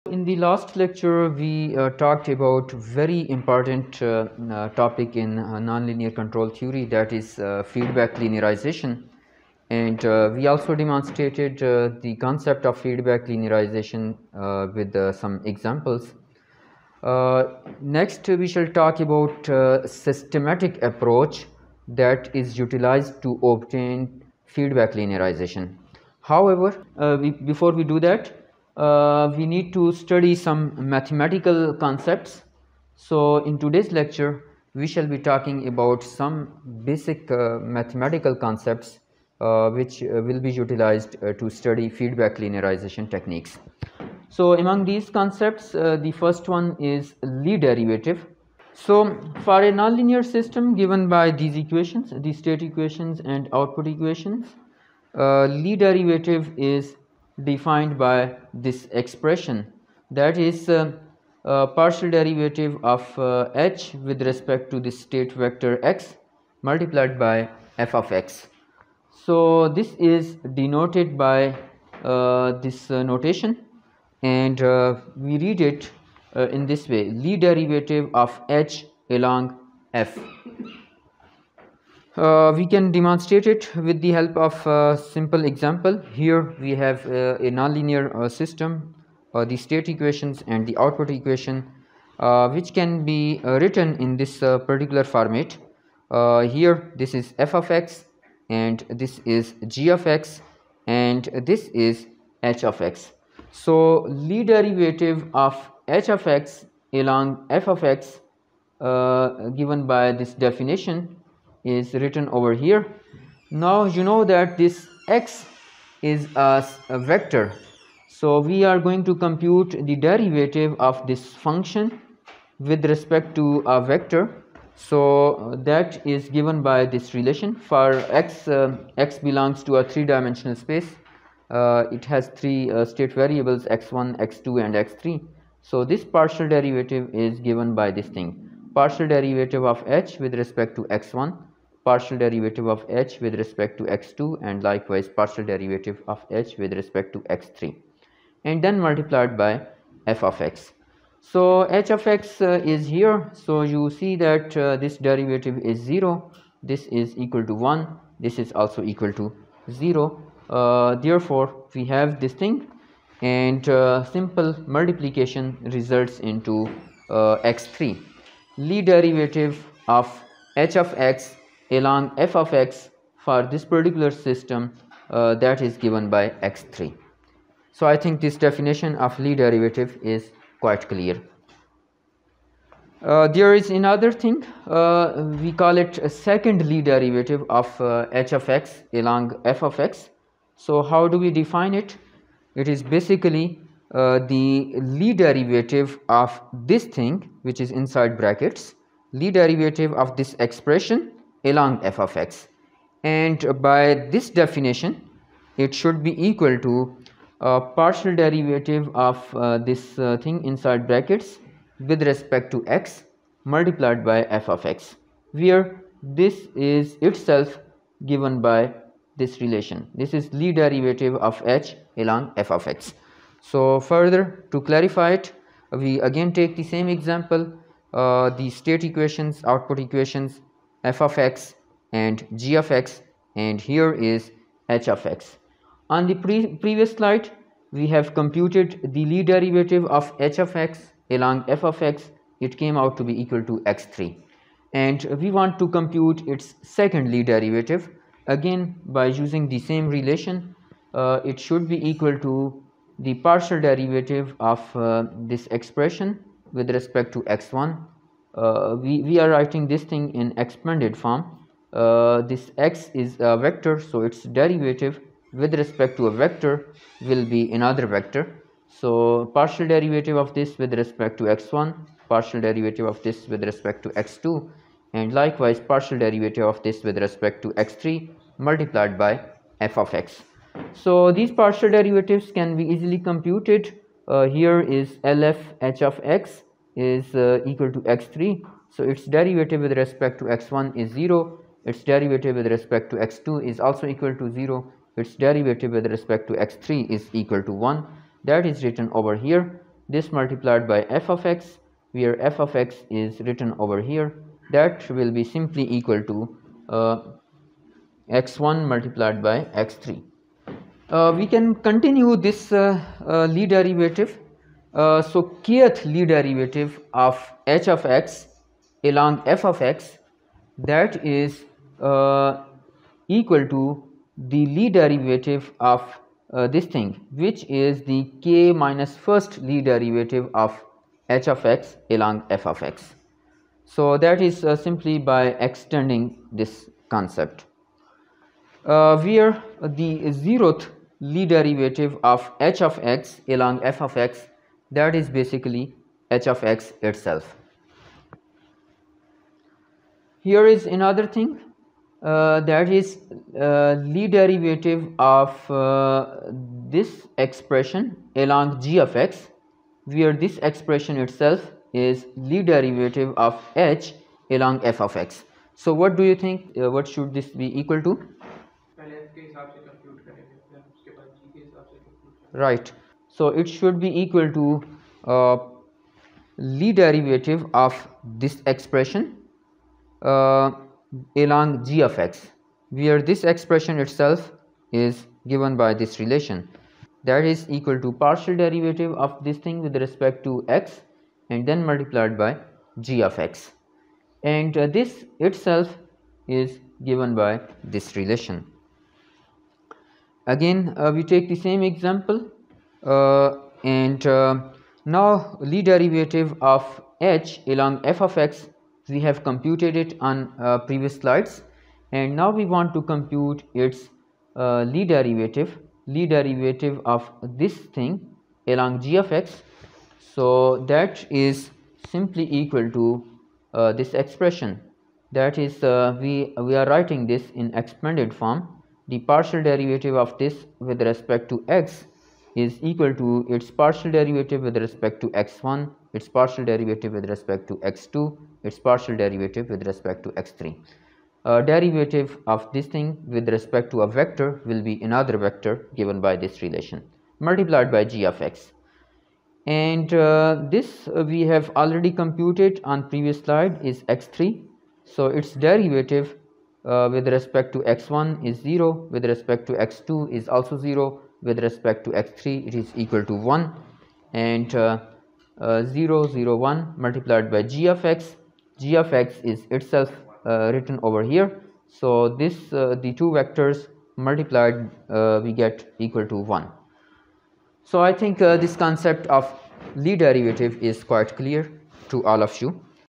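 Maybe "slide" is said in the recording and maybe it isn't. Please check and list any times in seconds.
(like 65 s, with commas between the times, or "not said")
236 s, 410 s, 453 s.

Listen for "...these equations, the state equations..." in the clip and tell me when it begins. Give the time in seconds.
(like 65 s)
51 s.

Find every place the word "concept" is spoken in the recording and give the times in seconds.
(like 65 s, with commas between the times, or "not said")
12 s, 31 s, 38 s, 45 s, 336 s, 478 s.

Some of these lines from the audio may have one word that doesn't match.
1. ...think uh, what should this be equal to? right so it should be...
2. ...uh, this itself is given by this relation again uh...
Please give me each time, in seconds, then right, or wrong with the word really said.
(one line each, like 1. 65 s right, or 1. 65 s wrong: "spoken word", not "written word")
1. 366 s right
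2. 394 s right.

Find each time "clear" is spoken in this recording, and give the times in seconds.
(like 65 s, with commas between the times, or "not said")
180 s, 481 s.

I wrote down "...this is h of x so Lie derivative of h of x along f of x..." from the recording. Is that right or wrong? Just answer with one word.
right.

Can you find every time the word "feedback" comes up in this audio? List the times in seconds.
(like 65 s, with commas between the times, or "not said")
7 s, 12 s, 24 s, 41 s.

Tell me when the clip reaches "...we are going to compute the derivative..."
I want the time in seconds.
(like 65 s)
118 s.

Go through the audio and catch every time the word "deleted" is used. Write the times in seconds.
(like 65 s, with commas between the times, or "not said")
not said.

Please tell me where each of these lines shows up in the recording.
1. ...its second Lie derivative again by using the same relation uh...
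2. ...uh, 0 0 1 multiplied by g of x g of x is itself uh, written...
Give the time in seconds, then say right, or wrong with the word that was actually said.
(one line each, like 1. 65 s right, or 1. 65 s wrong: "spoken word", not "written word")
1. 246 s right
2. 465 s right.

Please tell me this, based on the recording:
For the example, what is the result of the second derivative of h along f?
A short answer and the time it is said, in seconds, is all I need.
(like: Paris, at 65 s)
x1 multiplied by x3, at 308 s.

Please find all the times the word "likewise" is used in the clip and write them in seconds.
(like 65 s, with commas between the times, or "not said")
144 s, 275 s.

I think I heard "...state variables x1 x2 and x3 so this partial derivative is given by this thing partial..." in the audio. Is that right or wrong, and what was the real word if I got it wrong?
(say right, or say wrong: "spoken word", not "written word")
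right.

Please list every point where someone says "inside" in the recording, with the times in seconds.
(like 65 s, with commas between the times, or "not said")
197 s, 210 s.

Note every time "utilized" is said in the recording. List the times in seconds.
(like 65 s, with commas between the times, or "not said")
22 s, 40 s.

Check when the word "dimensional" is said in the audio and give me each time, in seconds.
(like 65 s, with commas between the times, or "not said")
130 s.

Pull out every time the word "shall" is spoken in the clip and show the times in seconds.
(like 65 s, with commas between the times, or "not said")
18 s, 34 s.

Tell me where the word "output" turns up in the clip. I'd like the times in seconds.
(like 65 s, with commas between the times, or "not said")
53 s, 90 s, 229 s.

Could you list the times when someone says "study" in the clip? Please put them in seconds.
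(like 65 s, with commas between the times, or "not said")
29 s, 41 s.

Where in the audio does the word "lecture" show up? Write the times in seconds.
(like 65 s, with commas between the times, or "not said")
0 s, 33 s.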